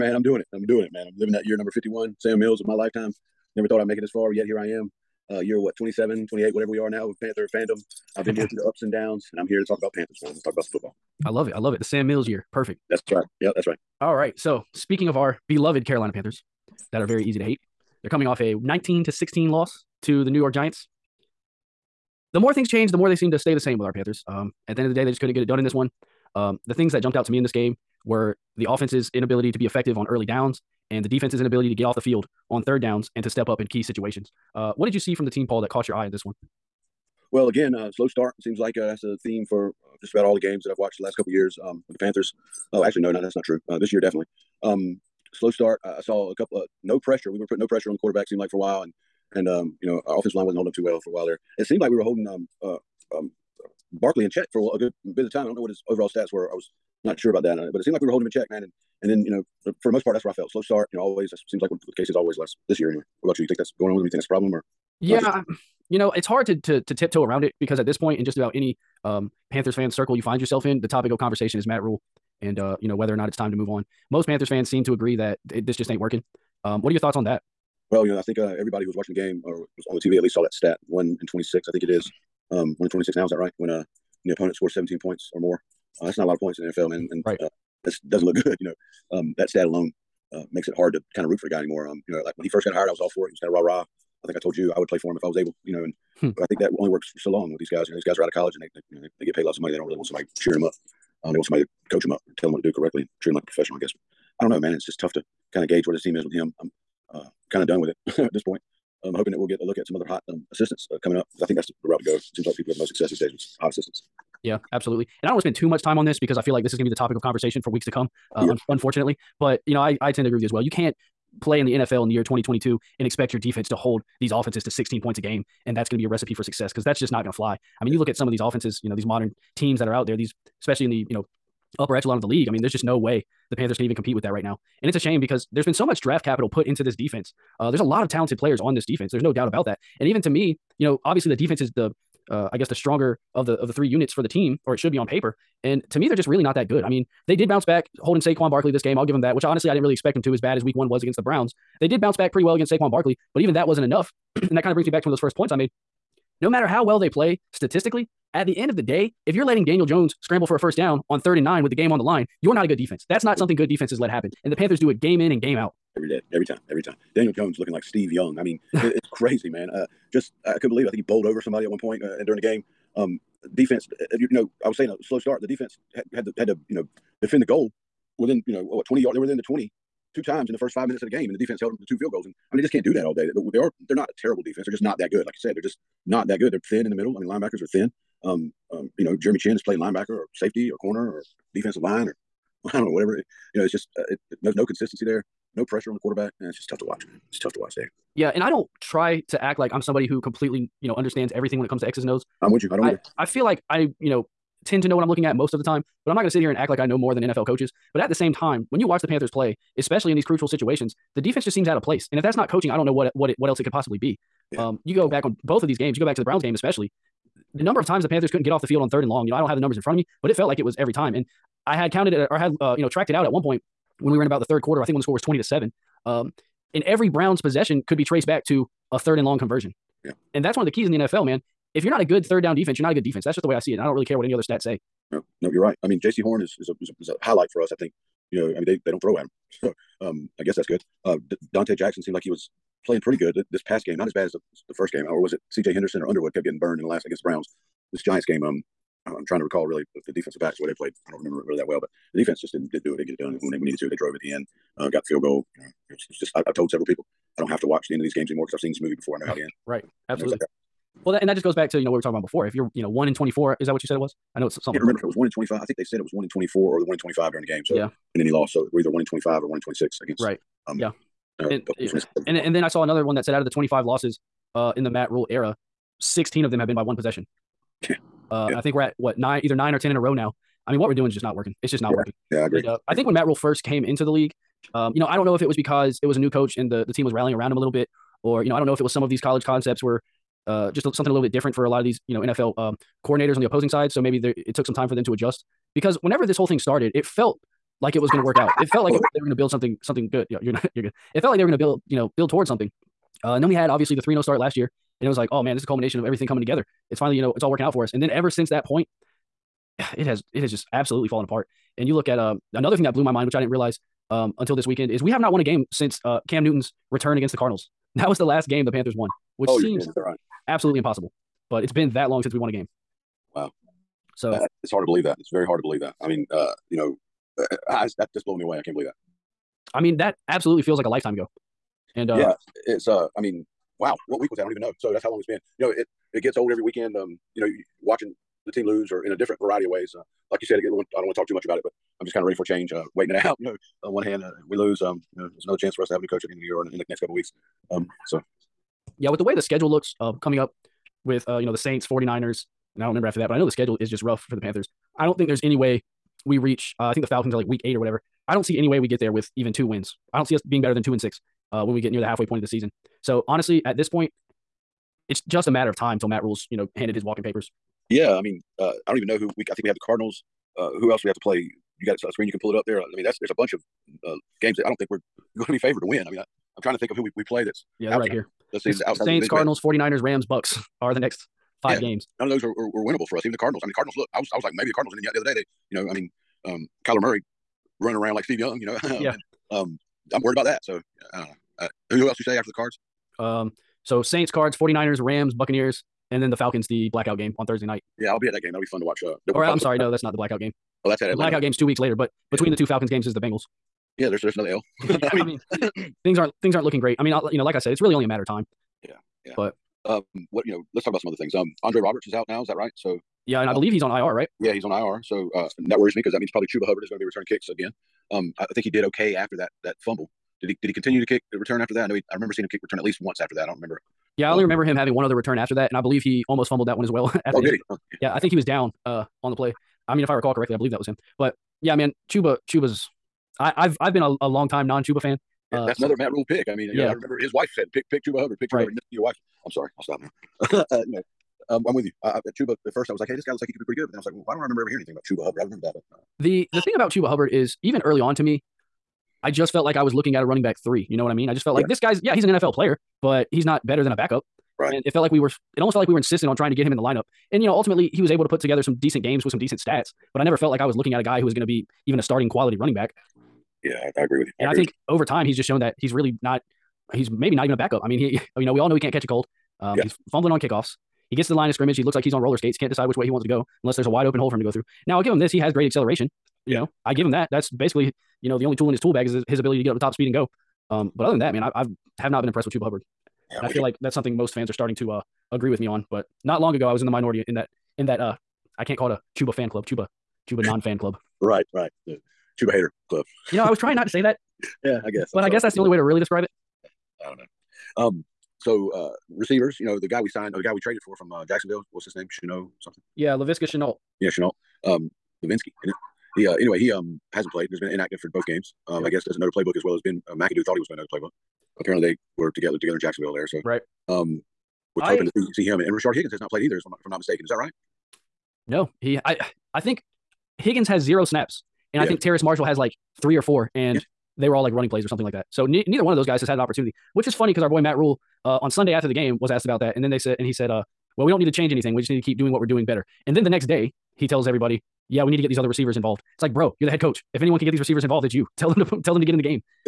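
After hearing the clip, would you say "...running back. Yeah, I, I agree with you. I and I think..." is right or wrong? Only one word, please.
right.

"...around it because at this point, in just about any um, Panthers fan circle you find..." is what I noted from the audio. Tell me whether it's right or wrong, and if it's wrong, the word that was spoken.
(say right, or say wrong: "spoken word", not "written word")
right.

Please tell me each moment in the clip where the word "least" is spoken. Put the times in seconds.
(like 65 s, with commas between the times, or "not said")
80 s, 422 s.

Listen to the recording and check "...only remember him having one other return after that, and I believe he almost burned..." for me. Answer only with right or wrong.
wrong.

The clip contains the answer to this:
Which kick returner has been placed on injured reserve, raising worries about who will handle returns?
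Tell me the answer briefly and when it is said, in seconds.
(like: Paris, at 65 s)
Andre Roberts, at 411 s.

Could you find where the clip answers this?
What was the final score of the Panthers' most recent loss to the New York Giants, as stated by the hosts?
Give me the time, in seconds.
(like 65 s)
18 s.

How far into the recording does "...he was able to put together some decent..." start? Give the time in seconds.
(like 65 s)
457 s.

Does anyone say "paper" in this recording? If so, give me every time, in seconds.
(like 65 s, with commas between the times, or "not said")
145 s, 367 s.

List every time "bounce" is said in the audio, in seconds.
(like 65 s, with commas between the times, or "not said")
147 s, 152 s.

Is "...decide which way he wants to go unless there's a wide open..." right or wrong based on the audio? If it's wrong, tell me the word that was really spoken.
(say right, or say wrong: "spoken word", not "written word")
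right.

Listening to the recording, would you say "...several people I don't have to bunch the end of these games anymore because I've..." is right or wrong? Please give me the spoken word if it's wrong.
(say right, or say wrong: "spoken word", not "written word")
wrong: "watch", not "bunch".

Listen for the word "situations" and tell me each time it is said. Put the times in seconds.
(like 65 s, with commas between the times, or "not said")
33 s, 210 s.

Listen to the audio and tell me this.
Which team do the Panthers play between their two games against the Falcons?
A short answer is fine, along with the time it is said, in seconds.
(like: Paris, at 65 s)
Bengals, at 403 s.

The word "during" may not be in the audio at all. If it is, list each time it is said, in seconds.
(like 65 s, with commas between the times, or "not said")
172 s, 267 s.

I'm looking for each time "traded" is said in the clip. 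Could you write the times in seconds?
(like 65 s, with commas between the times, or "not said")
500 s.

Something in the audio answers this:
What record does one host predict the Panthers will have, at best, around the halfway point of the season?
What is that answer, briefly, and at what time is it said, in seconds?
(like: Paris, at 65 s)
2 and 6, at 360 s.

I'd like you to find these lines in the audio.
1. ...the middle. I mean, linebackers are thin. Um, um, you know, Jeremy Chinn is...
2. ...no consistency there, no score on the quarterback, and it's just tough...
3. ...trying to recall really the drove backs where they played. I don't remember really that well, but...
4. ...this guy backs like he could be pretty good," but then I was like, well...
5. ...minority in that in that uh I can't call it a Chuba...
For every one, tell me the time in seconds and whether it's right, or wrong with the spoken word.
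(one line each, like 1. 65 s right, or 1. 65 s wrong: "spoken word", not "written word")
1. 186 s right
2. 194 s wrong: "pressure", not "score"
3. 249 s wrong: "defensive", not "drove"
4. 443 s wrong: "looks", not "backs"
5. 486 s right.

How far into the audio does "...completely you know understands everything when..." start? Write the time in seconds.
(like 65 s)
200 s.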